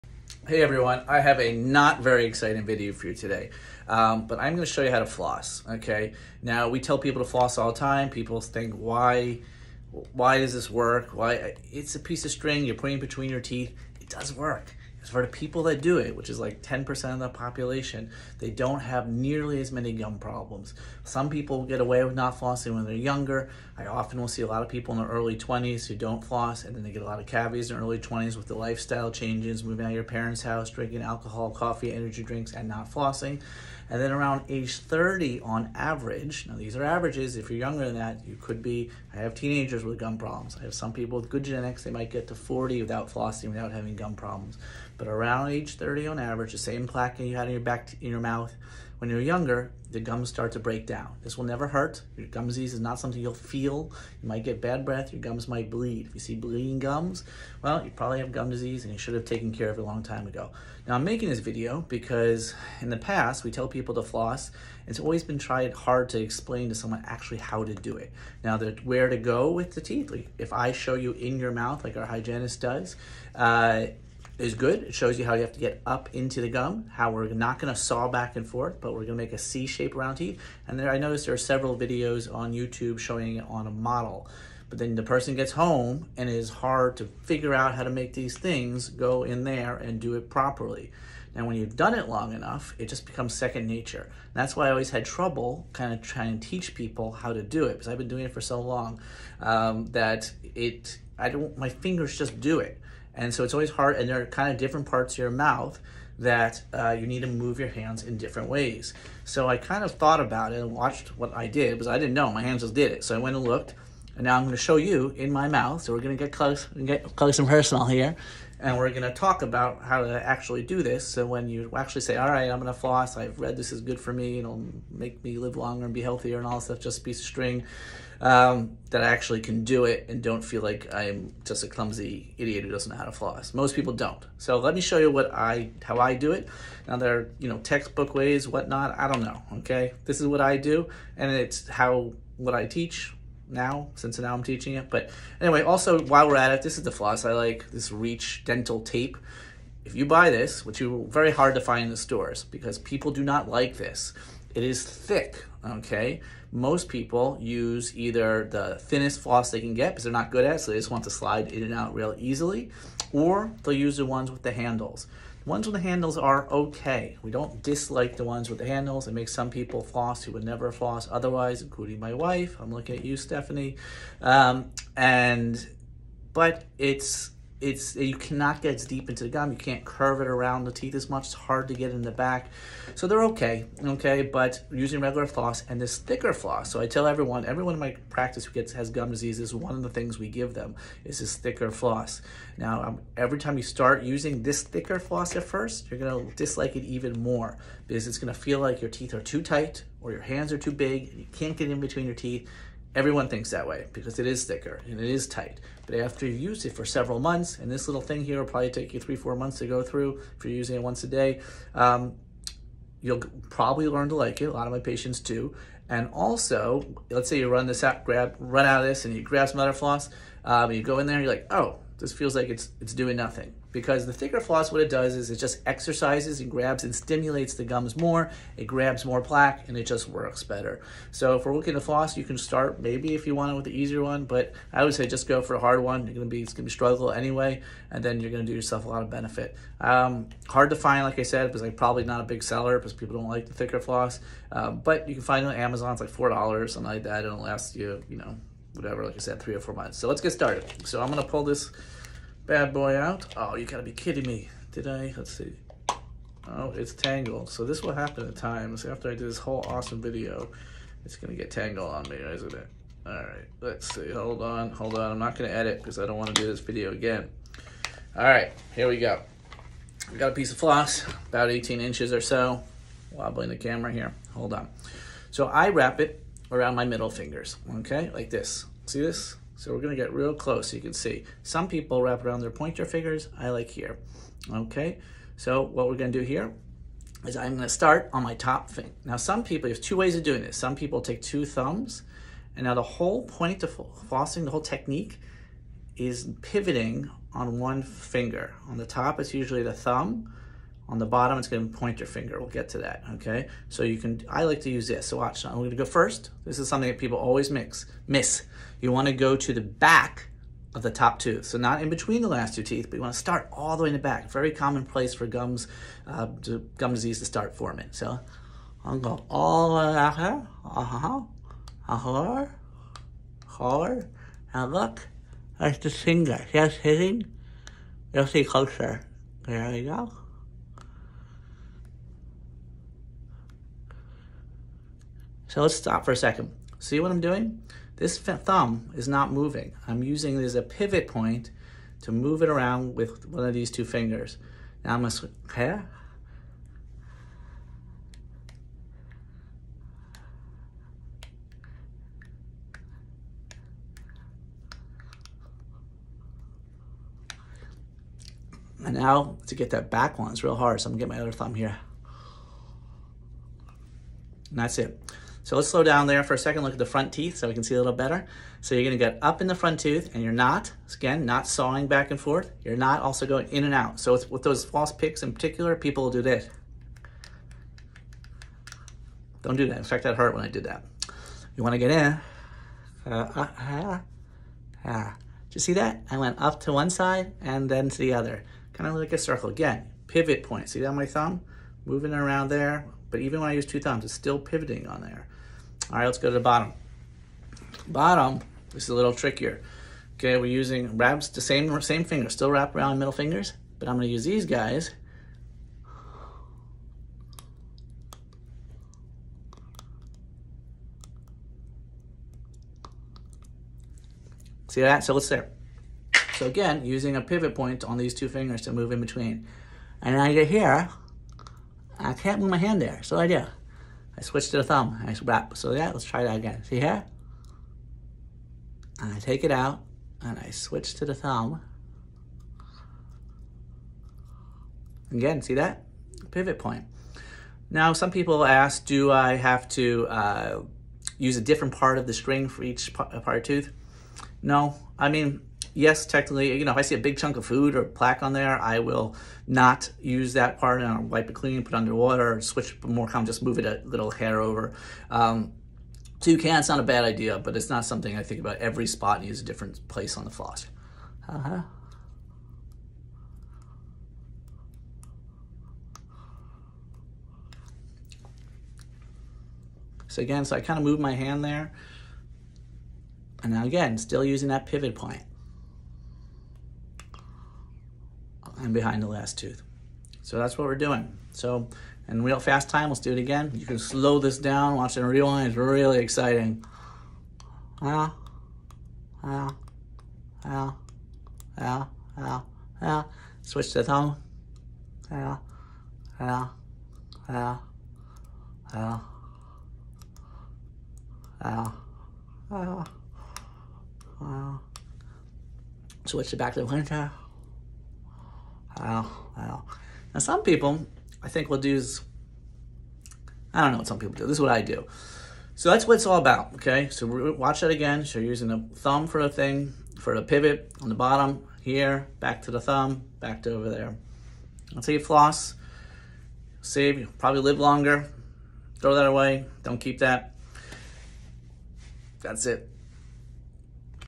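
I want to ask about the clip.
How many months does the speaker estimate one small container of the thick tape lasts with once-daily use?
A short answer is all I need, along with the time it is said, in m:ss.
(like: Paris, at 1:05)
3 to 4 months, at 3:28.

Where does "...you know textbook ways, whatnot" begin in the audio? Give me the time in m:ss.
2:17.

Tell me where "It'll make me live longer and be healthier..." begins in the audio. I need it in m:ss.
2:04.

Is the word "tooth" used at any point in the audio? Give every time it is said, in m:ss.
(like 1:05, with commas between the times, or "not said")
5:11, 6:09, 7:23, 7:59.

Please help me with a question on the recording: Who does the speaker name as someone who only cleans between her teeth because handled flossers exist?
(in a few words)
Stephanie.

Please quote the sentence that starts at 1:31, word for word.
Now, when you've done it long enough, it just becomes second nature.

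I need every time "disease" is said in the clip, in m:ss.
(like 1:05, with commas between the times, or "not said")
0:52, 0:58, 3:09, 5:16.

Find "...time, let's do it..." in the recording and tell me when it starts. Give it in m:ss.
8:02.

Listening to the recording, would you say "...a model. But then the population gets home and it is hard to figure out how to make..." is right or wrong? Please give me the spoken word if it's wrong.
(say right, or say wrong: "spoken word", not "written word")
wrong: "person", not "population".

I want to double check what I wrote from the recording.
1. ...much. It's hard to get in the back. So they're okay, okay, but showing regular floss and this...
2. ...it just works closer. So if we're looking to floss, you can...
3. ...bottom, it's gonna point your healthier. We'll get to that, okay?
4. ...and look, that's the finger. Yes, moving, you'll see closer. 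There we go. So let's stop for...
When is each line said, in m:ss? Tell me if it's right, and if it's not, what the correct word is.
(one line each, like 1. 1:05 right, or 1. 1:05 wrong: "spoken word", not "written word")
1. 3:01 wrong: "using", not "showing"
2. 3:49 wrong: "better", not "closer"
3. 5:01 wrong: "finger", not "healthier"
4. 5:24 wrong: "hitting", not "moving".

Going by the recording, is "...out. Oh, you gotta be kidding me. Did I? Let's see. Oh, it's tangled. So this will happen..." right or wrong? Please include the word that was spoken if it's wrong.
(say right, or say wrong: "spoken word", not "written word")
right.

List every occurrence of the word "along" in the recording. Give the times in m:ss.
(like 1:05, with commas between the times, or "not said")
not said.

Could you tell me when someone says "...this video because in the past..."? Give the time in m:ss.
1:01.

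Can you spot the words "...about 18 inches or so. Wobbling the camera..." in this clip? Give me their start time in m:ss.
4:31.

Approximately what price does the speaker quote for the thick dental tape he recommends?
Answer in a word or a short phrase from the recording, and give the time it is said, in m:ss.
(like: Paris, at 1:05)
$4, at 4:06.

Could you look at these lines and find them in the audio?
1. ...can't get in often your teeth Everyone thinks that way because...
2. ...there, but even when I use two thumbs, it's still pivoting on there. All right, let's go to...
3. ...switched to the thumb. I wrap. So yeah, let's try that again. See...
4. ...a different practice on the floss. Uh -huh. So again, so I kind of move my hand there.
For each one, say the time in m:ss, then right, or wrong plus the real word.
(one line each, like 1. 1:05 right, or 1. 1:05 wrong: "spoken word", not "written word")
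1. 3:21 wrong: "between", not "often"
2. 6:32 right
3. 7:04 right
4. 7:39 wrong: "place", not "practice".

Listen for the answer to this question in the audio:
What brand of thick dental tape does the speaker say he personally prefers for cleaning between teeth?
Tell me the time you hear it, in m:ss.
2:27.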